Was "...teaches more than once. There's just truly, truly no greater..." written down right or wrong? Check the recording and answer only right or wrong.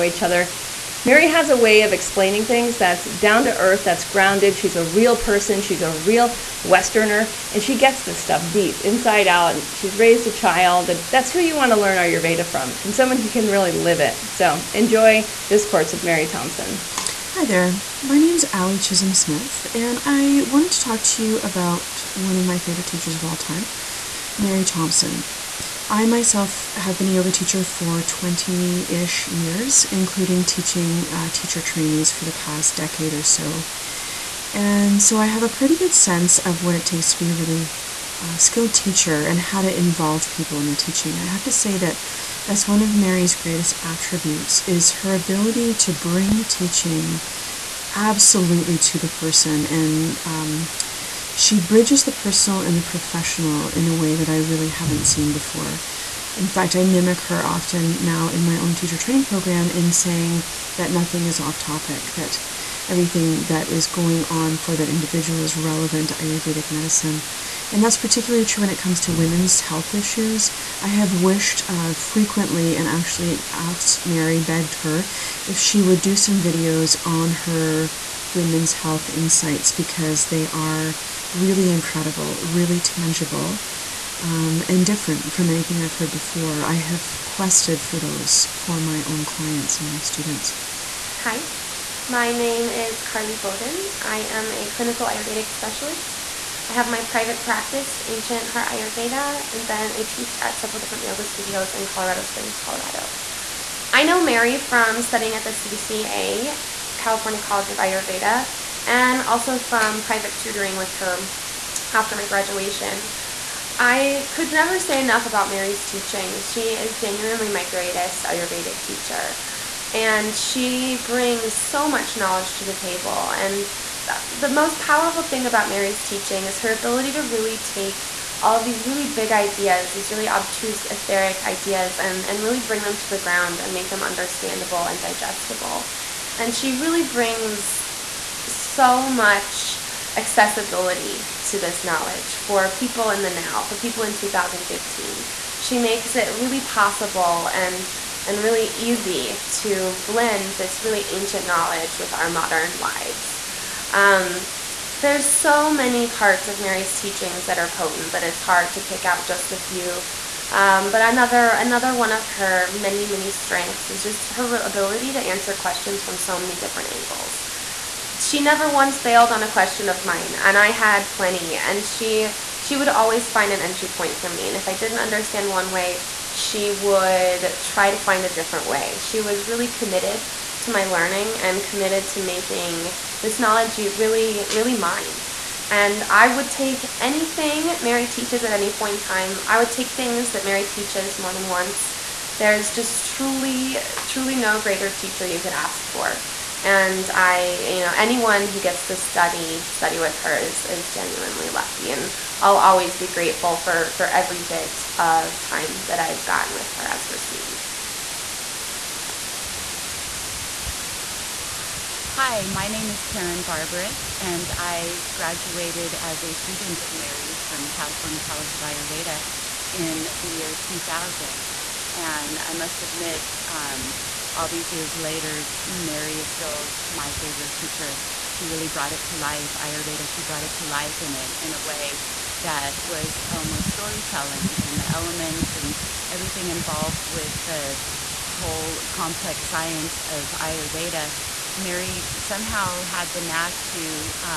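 right.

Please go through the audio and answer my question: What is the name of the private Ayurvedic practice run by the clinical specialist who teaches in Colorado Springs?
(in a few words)
Ancient Heart Ayurveda.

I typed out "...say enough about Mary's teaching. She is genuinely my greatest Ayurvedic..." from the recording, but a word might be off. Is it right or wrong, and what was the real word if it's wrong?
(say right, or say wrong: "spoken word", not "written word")
right.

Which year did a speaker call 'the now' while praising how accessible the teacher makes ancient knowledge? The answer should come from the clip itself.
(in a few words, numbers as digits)
2015.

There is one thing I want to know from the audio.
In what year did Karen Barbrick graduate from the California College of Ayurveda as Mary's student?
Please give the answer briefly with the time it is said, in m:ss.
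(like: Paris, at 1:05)
2000, at 3:40.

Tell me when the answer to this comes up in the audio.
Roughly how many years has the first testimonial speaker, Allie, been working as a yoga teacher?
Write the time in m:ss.
0:28.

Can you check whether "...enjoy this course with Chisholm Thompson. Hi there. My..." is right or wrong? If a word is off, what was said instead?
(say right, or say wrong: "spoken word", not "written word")
wrong: "Mary", not "Chisholm".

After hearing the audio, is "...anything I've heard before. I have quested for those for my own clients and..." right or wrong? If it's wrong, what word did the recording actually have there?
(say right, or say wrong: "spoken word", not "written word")
right.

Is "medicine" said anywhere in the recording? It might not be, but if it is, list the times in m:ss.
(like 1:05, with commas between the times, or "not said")
1:06.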